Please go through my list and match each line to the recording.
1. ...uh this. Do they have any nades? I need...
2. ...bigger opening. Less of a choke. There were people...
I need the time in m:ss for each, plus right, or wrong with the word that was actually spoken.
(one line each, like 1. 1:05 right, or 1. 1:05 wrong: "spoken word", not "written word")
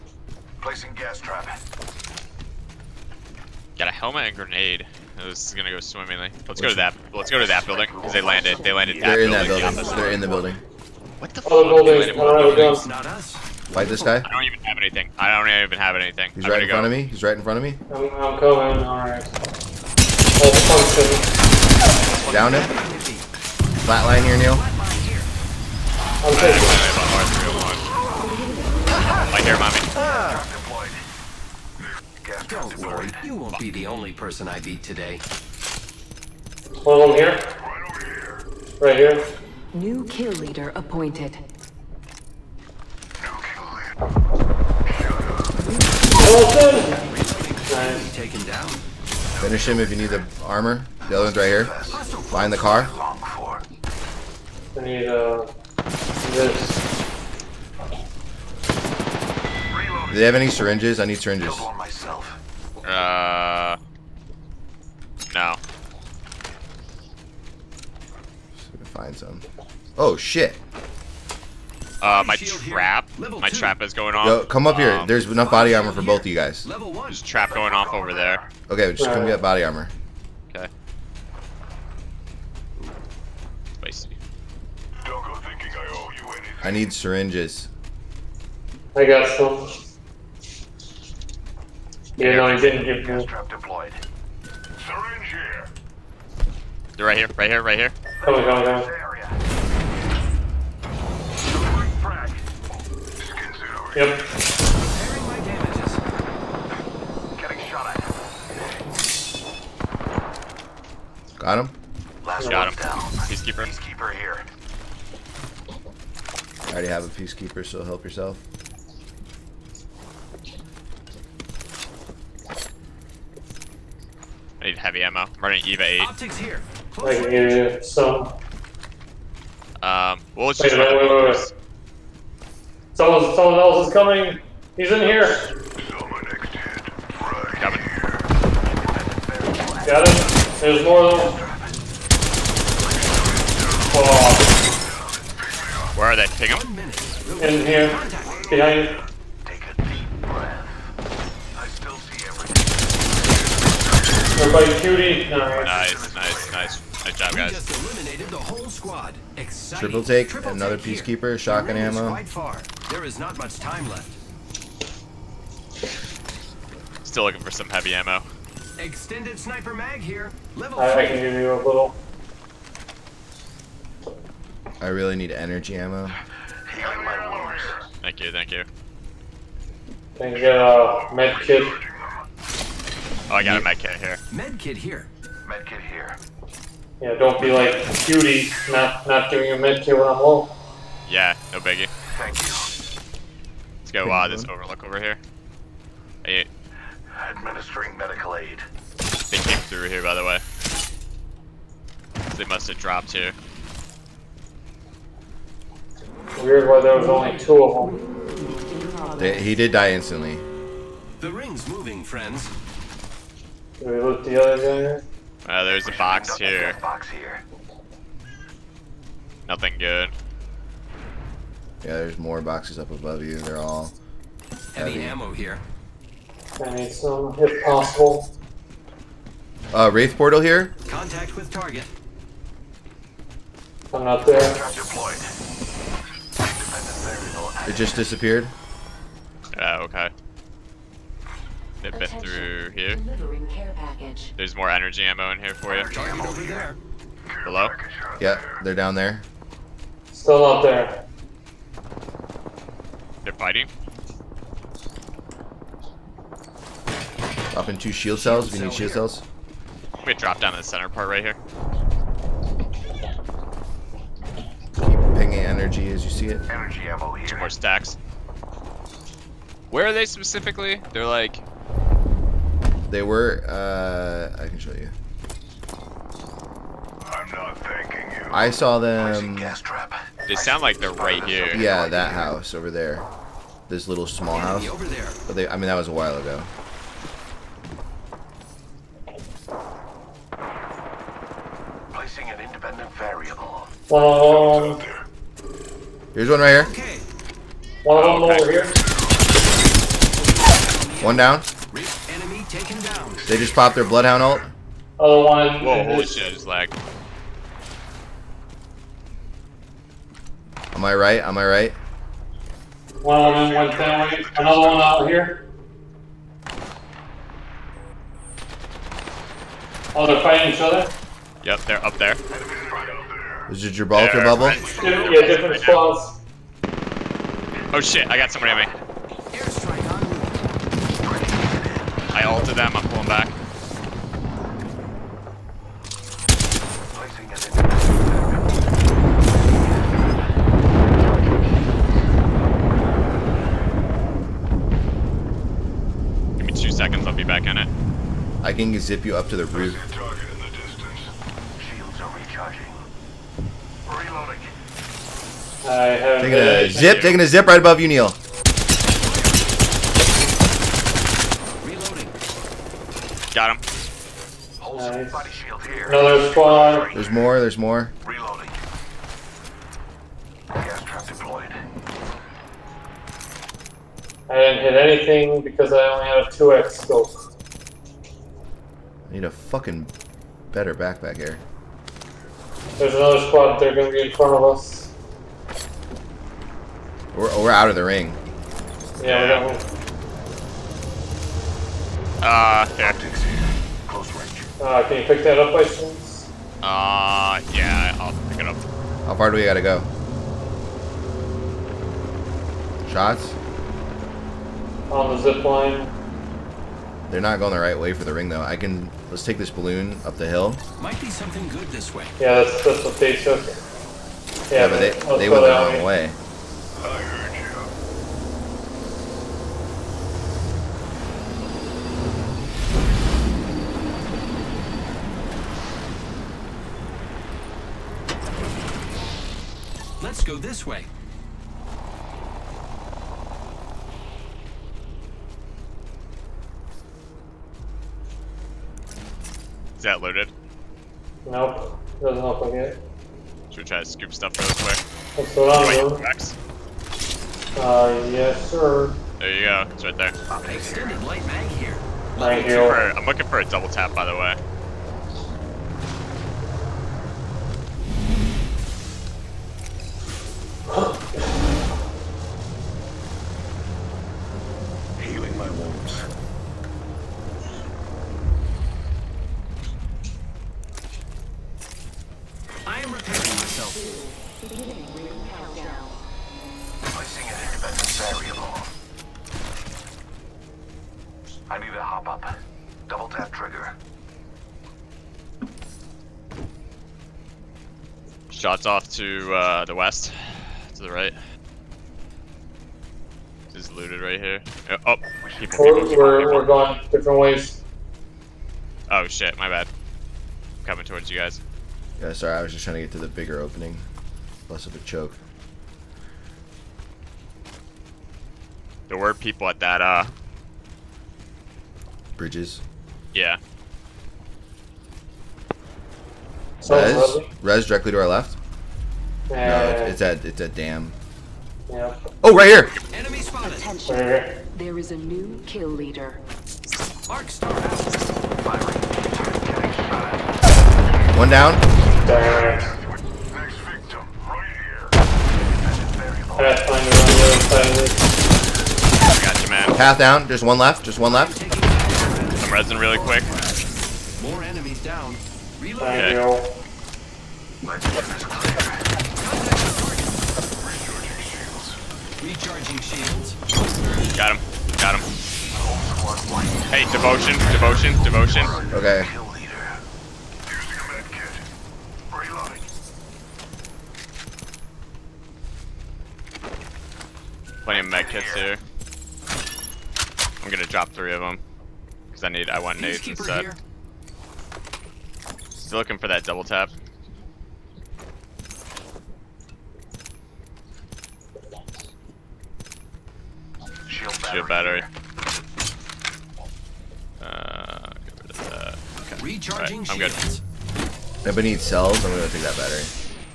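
1. 0:55 wrong: "syringes", not "nades"
2. 8:23 right.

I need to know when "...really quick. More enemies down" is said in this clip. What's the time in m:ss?
9:02.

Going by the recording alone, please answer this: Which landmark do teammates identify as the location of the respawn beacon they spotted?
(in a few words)
Dam.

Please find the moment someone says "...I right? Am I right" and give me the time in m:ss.
5:10.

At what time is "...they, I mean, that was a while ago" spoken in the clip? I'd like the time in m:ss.
4:45.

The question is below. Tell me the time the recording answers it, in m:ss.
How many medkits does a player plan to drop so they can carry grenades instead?
9:30.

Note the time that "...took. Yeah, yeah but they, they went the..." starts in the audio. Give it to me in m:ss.
6:53.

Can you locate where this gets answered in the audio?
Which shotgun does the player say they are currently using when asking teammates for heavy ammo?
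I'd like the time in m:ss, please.
2:05.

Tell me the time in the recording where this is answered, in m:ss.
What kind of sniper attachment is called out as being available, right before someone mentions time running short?
2:48.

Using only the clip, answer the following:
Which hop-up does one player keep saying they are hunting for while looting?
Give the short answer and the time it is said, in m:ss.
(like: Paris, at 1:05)
Double tap trigger, at 8:02.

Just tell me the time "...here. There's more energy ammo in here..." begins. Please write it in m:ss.
4:02.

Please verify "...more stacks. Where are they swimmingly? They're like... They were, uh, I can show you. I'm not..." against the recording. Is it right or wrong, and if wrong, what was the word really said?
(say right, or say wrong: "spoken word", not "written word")
wrong: "specifically", not "swimmingly".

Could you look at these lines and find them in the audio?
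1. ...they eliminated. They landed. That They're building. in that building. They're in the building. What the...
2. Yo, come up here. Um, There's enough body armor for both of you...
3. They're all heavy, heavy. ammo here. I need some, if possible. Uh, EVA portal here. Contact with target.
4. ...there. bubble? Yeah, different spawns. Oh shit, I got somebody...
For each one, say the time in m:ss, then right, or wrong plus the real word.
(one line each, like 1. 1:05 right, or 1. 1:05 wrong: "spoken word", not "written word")
1. 0:08 wrong: "landed", not "eliminated"
2. 1:14 right
3. 3:43 wrong: "Wraith", not "EVA"
4. 5:24 right.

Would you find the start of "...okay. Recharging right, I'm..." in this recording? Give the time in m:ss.
9:49.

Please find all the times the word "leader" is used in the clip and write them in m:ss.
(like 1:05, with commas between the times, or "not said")
0:40, 8:45.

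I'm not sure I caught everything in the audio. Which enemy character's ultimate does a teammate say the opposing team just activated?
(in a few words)
Bloodhound.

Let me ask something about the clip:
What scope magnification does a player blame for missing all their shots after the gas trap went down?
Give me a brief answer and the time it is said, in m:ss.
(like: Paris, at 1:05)
2x, at 6:15.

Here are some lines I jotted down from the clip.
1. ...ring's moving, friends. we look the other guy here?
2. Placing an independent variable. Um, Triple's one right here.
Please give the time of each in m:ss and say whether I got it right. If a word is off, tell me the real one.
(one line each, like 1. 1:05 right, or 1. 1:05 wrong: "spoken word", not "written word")
1. 3:31 right
2. 4:51 wrong: "Here", not "Triple".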